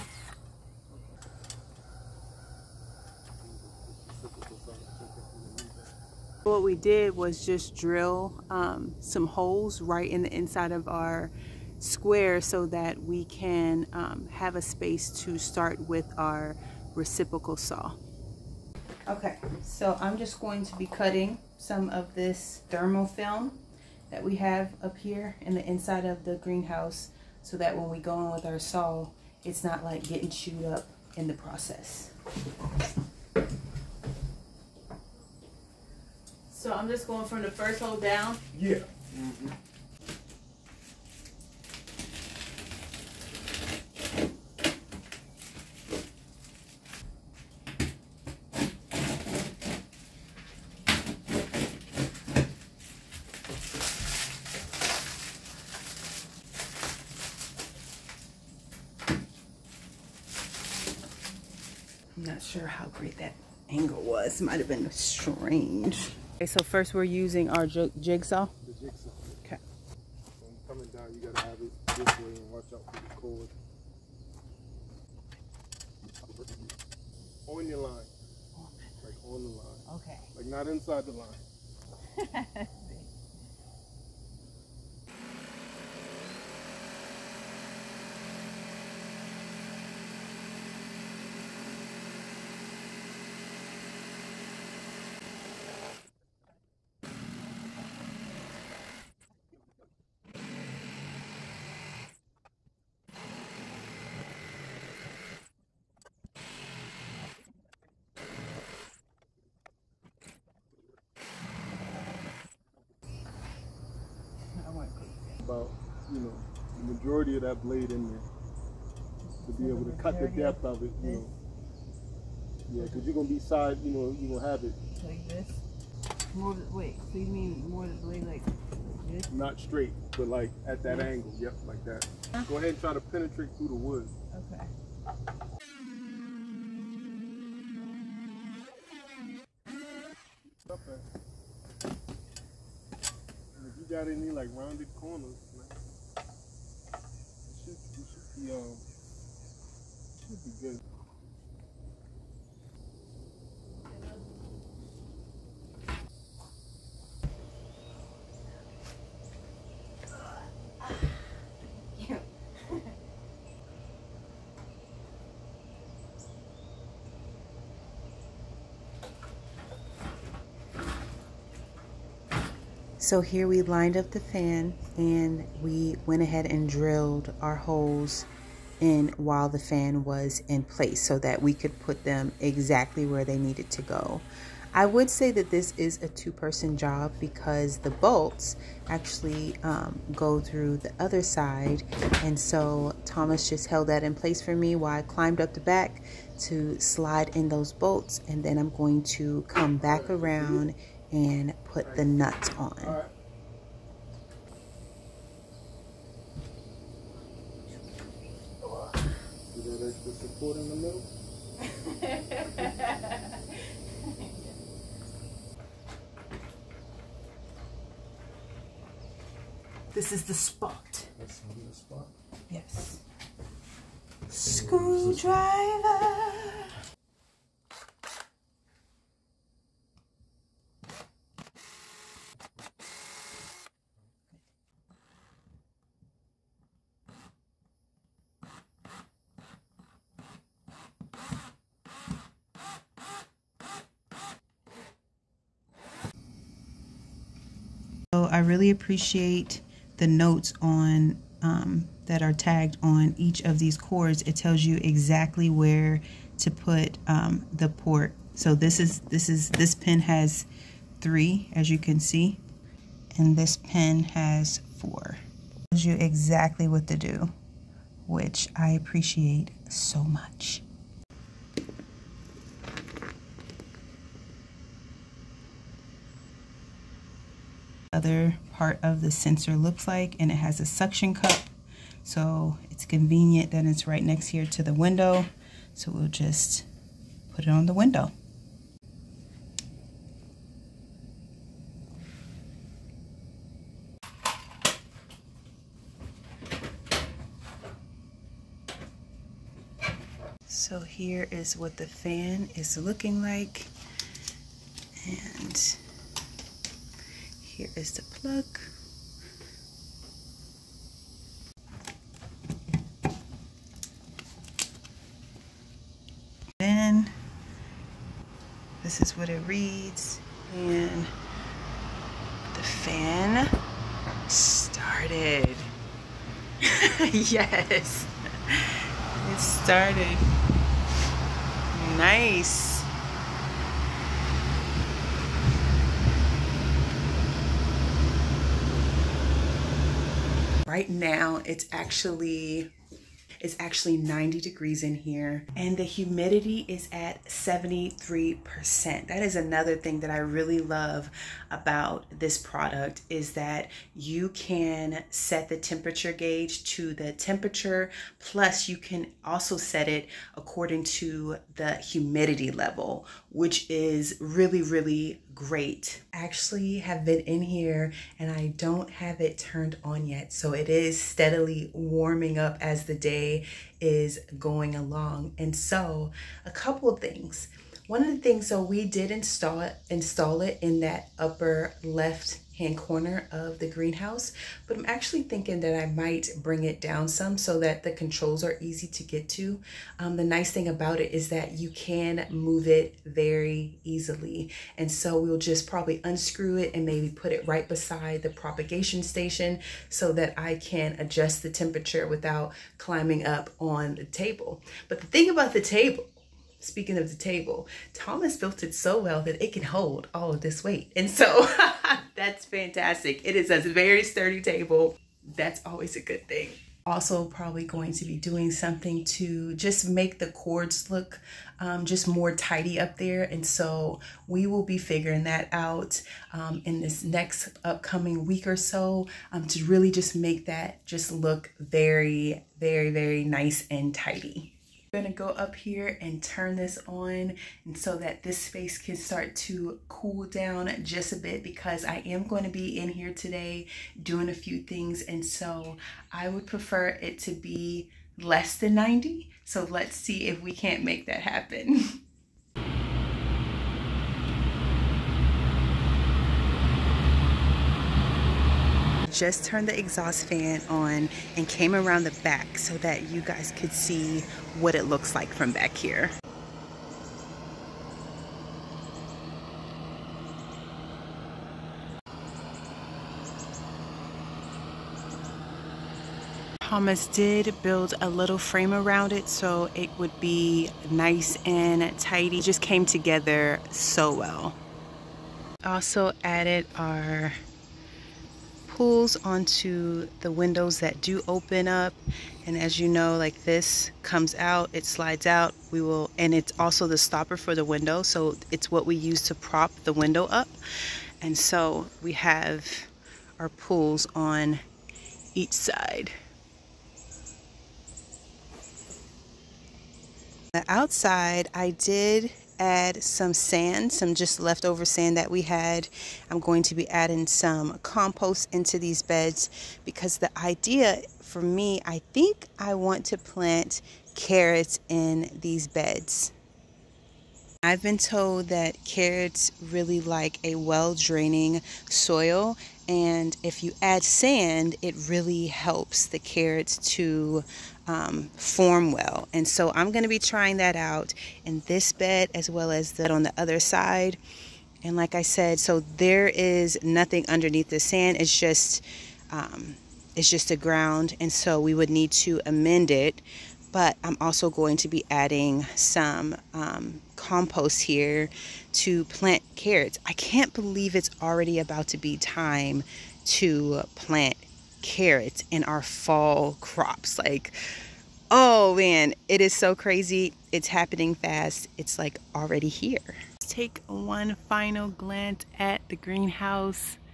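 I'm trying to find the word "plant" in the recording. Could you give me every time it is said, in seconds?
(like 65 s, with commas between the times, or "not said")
523 s, 559 s, 563 s.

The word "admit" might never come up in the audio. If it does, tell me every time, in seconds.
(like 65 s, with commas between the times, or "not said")
not said.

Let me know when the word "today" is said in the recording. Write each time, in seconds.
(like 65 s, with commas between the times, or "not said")
443 s.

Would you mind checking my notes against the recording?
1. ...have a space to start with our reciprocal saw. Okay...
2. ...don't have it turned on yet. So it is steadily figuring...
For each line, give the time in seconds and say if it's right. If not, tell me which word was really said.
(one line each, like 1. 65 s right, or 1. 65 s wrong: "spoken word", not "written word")
1. 14 s right
2. 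368 s wrong: "warming", not "figuring".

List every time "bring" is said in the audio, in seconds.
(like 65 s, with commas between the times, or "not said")
386 s.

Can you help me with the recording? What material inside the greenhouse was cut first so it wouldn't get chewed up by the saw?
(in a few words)
thermal film.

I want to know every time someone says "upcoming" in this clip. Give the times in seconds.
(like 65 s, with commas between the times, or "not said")
427 s.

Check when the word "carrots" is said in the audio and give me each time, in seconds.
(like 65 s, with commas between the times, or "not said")
524 s, 528 s, 536 s, 559 s, 564 s.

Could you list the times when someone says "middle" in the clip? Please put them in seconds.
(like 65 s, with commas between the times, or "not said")
not said.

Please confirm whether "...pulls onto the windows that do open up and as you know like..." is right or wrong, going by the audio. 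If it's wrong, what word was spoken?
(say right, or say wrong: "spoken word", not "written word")
right.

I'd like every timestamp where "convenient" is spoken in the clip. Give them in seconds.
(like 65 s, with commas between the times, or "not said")
282 s.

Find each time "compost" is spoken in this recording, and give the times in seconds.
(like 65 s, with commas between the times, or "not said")
517 s, 557 s.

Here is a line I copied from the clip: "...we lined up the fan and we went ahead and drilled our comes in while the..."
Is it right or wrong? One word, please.
wrong.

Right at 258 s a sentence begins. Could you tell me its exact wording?
So this is this is this pin has three, as you can see, and this pin has four.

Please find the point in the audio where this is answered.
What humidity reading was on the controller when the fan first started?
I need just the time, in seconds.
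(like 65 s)
347 s.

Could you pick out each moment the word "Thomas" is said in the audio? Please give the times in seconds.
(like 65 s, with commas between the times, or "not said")
193 s, 407 s, 476 s.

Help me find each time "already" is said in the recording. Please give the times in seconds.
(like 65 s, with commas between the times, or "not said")
561 s, 572 s.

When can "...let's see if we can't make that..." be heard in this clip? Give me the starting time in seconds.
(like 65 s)
449 s.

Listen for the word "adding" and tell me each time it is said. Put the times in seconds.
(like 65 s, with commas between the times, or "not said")
516 s, 555 s.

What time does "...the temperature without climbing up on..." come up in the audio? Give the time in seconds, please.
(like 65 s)
401 s.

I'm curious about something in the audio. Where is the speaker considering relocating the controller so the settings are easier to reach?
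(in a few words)
beside the propagation station.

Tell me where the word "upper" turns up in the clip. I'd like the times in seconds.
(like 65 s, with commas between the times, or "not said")
381 s.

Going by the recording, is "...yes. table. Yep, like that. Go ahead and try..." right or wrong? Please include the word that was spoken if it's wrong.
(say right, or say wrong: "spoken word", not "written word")
wrong: "angle", not "table".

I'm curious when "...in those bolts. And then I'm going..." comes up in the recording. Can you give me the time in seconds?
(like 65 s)
197 s.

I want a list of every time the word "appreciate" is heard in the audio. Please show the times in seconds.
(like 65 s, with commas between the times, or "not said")
248 s, 268 s.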